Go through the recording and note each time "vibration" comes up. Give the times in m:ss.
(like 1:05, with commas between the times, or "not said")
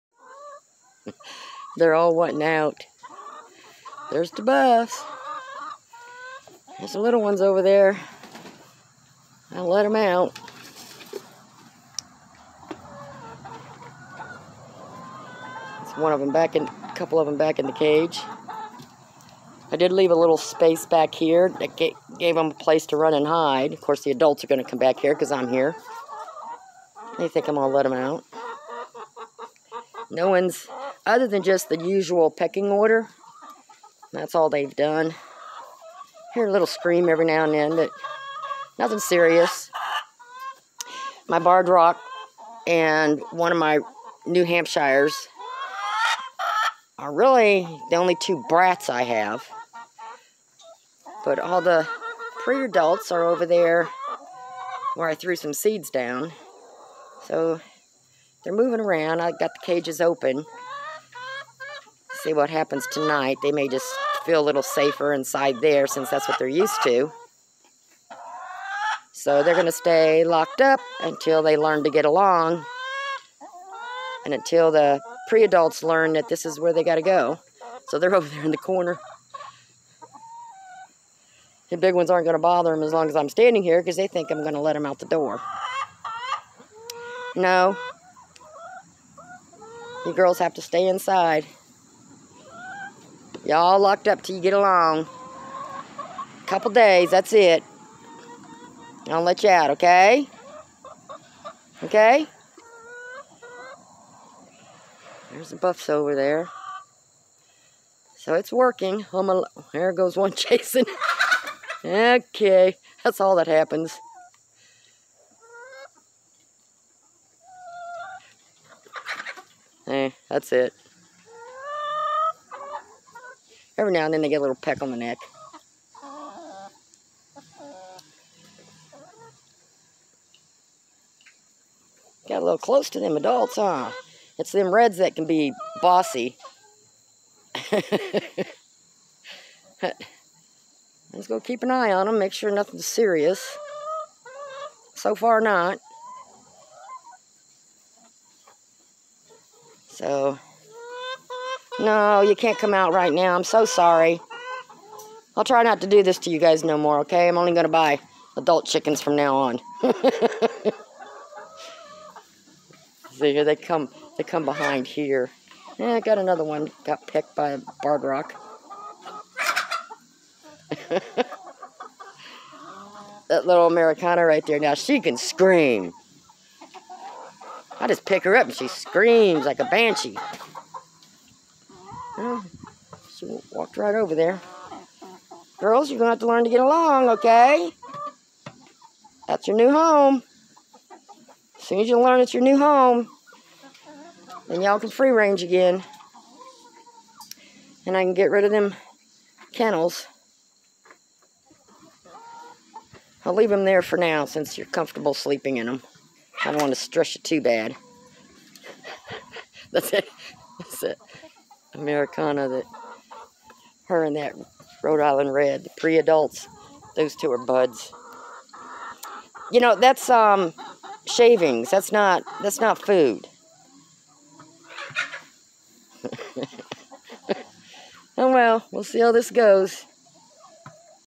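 not said.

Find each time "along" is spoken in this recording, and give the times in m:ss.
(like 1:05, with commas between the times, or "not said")
1:12, 1:34, 3:06.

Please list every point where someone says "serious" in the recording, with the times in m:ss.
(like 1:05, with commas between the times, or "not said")
0:38, 2:22.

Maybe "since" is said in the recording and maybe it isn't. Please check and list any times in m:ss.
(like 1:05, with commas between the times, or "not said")
1:05, 3:24.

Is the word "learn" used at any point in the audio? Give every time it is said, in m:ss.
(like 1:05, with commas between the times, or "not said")
1:11, 1:15, 3:06, 3:12.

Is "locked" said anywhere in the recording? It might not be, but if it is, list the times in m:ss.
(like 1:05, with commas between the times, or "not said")
1:10, 1:33.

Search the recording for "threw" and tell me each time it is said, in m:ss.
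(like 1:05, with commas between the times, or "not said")
0:55.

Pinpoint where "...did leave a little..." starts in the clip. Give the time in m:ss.
0:19.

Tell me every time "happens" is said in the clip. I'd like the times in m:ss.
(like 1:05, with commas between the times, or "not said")
1:02, 1:53.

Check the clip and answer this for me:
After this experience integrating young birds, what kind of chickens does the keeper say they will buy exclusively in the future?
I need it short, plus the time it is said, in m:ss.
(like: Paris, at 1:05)
Adult chickens, at 2:38.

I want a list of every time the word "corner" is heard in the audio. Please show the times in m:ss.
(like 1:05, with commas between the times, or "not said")
1:18.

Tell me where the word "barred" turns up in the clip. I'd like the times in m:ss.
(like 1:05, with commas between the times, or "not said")
0:41, 2:47.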